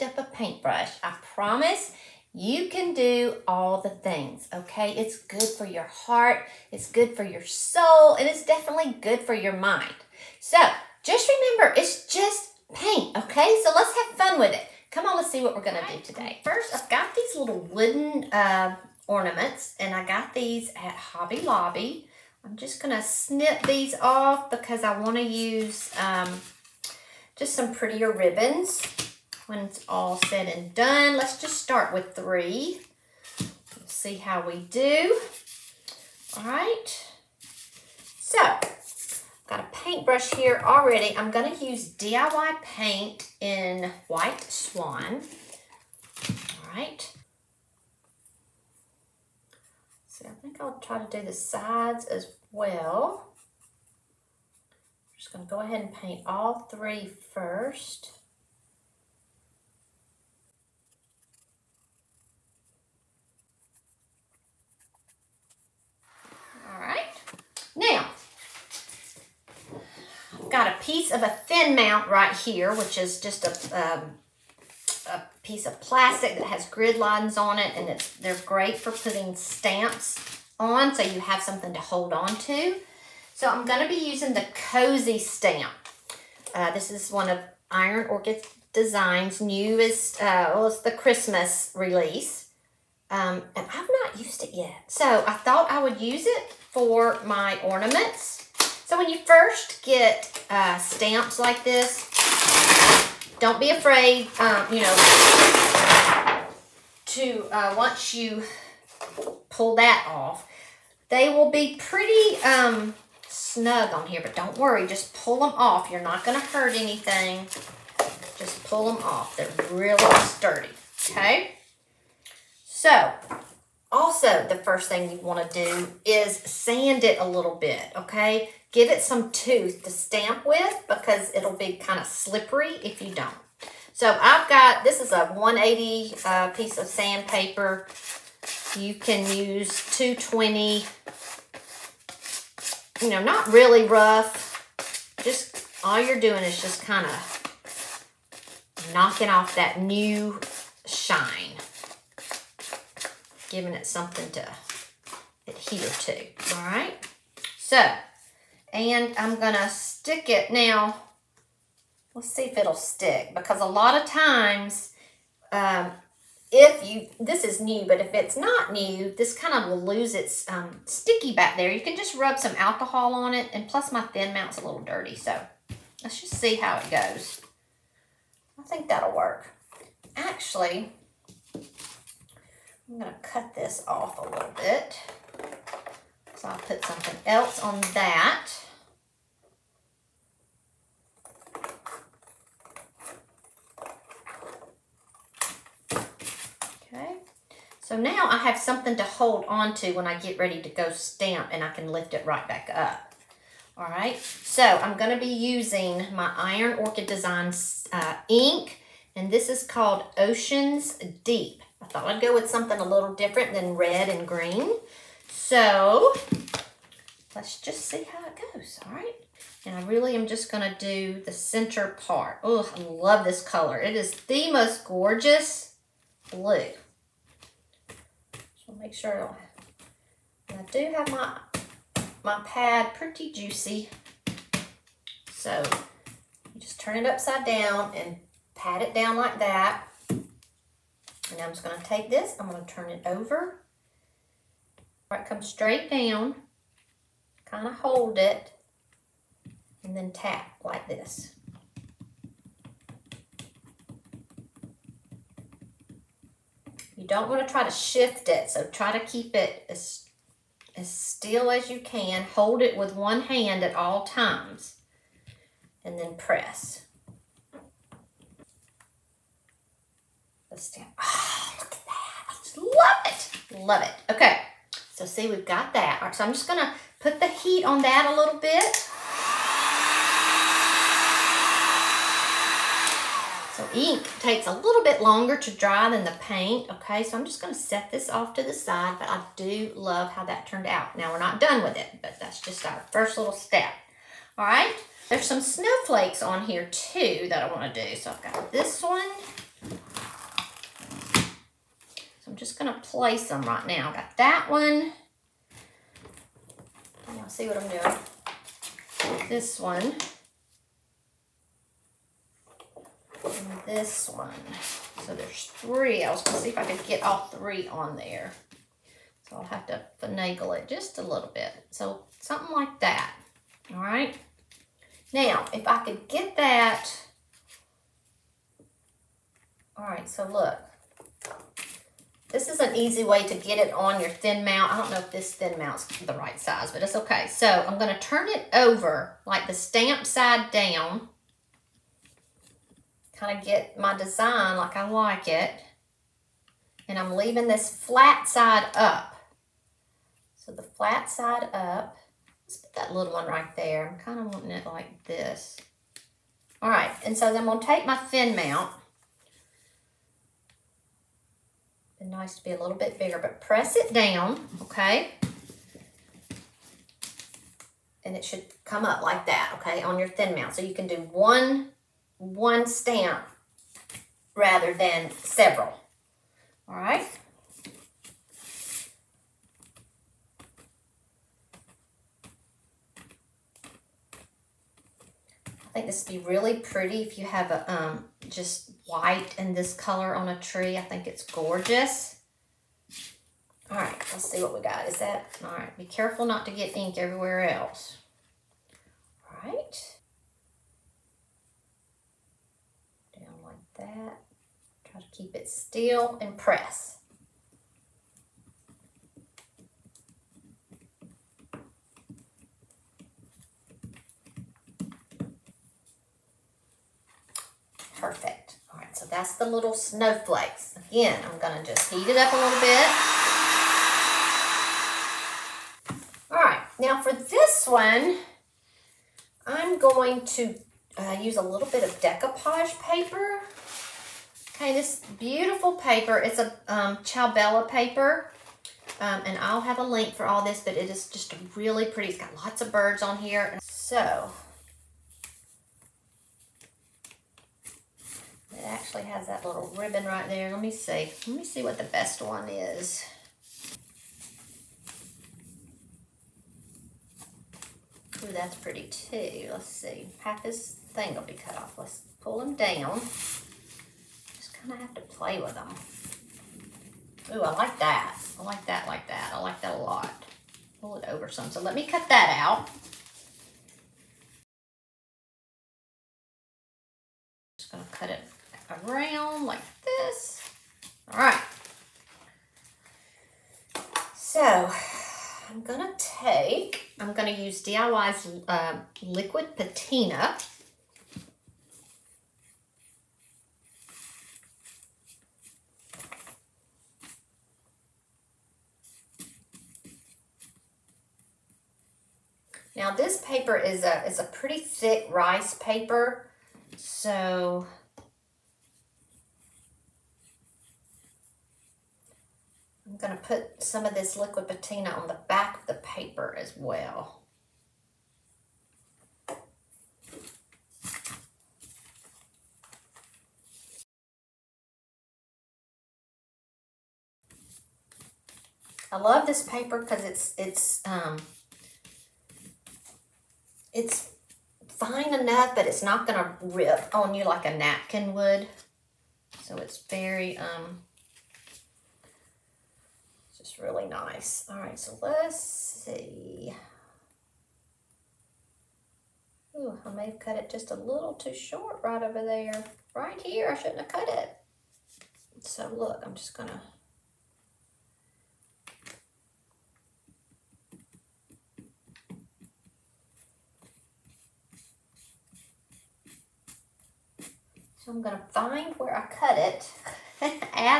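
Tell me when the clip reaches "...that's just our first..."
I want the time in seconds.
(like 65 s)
292 s.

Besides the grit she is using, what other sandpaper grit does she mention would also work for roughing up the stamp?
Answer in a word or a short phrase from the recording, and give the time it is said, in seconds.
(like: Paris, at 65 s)
220, at 139 s.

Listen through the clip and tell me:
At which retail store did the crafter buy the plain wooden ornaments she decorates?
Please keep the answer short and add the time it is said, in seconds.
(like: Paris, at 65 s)
Hobby Lobby, at 20 s.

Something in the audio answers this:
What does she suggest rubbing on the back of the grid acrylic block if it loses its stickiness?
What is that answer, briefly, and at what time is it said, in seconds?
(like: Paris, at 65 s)
alcohol, at 172 s.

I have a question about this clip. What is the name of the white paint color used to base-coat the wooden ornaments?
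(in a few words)
White Swan.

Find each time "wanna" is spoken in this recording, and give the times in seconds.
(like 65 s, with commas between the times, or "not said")
24 s, 125 s, 297 s.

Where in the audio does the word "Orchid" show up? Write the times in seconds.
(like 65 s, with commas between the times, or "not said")
88 s, 206 s.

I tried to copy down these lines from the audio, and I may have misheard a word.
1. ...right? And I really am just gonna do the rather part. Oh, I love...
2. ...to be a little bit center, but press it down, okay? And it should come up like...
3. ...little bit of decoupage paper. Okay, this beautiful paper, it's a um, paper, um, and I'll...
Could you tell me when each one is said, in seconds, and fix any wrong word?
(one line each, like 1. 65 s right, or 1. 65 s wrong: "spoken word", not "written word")
1. 218 s wrong: "center", not "rather"
2. 362 s wrong: "bigger", not "center"
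3. 431 s right.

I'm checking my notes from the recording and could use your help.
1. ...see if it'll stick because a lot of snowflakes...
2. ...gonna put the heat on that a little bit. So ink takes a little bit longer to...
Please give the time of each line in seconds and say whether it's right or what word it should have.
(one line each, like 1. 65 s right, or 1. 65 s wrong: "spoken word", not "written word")
1. 162 s wrong: "times", not "snowflakes"
2. 276 s right.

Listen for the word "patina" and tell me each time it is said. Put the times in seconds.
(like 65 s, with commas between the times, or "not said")
489 s, 514 s.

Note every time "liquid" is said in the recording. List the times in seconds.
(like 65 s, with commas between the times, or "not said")
489 s, 514 s.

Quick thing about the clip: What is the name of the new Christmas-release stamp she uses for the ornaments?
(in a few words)
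Cozy.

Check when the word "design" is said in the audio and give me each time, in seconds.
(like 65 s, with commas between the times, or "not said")
88 s, 207 s, 343 s.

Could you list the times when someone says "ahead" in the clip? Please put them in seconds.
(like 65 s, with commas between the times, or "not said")
55 s.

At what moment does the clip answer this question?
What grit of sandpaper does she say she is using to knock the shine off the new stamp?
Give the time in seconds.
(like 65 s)
135 s.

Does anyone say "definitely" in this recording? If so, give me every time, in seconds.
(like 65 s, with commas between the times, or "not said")
8 s.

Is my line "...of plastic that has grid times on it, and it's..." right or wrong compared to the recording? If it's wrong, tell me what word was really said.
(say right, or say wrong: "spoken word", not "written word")
wrong: "lines", not "times".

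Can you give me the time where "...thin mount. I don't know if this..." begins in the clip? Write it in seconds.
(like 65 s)
334 s.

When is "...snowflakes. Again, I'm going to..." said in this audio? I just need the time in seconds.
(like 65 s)
419 s.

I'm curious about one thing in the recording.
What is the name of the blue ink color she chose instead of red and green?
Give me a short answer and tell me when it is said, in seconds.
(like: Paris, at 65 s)
Oceans Deep, at 210 s.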